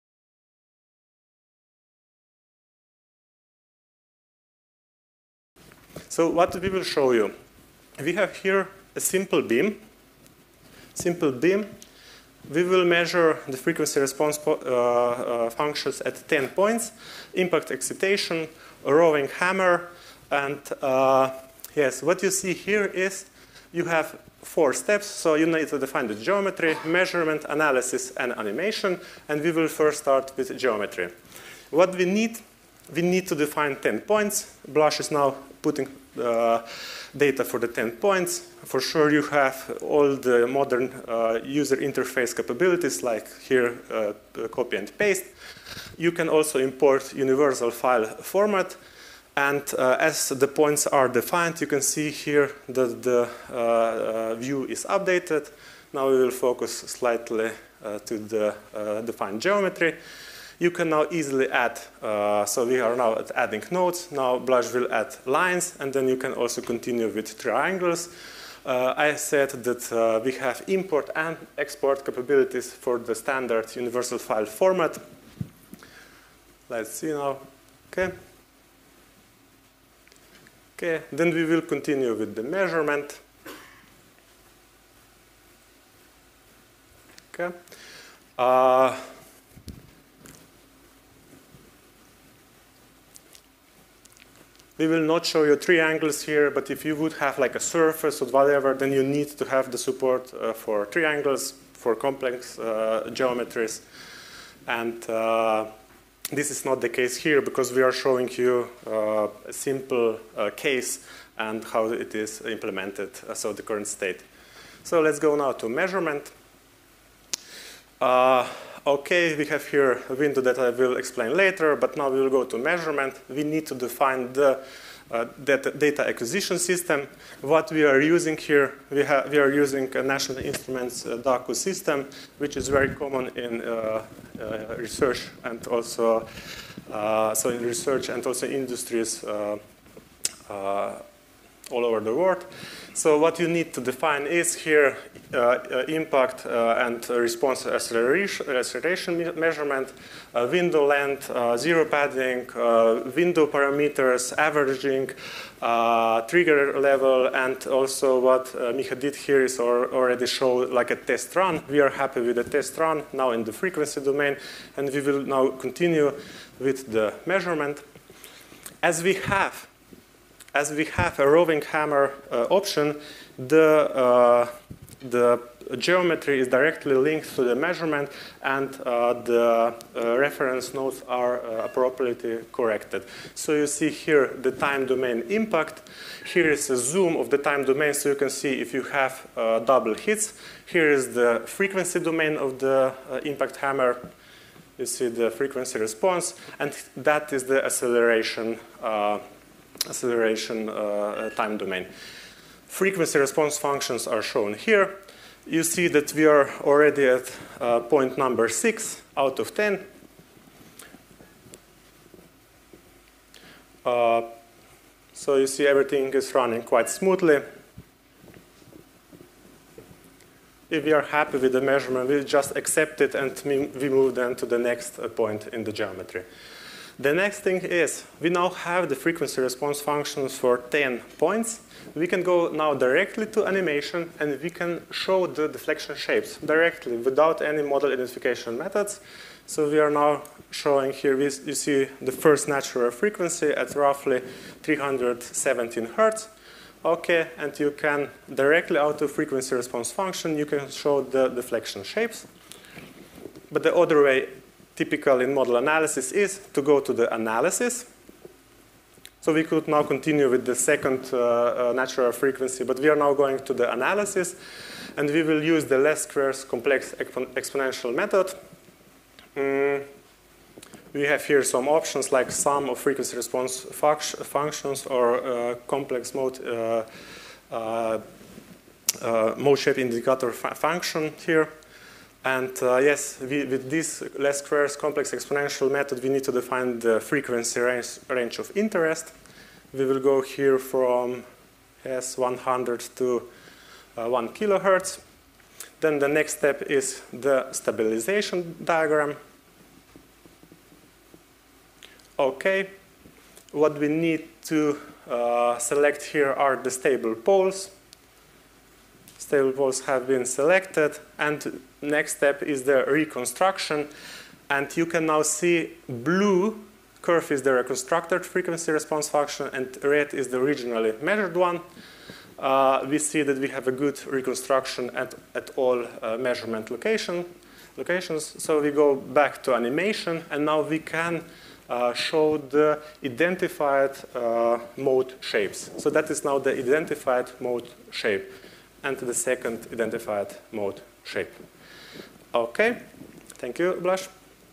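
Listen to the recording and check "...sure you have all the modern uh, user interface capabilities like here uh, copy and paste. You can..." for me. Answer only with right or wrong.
right.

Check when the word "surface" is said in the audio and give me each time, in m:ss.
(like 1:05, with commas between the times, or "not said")
1:37.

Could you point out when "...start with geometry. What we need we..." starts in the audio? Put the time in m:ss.
0:29.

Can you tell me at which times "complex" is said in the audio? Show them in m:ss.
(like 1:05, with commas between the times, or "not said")
1:41, 4:26, 4:35, 4:44.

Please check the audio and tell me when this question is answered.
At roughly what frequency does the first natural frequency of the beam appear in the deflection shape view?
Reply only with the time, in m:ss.
4:04.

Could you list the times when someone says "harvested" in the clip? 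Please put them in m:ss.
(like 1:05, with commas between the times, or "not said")
not said.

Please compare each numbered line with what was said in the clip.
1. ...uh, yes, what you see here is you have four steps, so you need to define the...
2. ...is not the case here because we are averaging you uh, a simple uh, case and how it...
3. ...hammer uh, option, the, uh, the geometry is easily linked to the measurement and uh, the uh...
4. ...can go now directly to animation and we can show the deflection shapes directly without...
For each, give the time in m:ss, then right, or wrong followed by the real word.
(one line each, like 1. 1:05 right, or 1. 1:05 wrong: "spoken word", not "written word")
1. 0:20 right
2. 1:46 wrong: "showing", not "averaging"
3. 2:51 wrong: "directly", not "easily"
4. 3:52 right.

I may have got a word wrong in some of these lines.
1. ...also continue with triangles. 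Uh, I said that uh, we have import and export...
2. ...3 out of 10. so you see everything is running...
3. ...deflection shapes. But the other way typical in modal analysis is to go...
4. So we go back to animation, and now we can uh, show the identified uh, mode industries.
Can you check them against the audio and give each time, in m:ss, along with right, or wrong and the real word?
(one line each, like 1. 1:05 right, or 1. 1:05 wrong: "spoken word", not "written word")
1. 1:06 right
2. 3:28 wrong: "6", not "3"
3. 4:11 right
4. 5:28 wrong: "shapes", not "industries".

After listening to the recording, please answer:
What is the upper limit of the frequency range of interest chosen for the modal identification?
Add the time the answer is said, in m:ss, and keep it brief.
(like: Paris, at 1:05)
1 kilohertz, at 4:54.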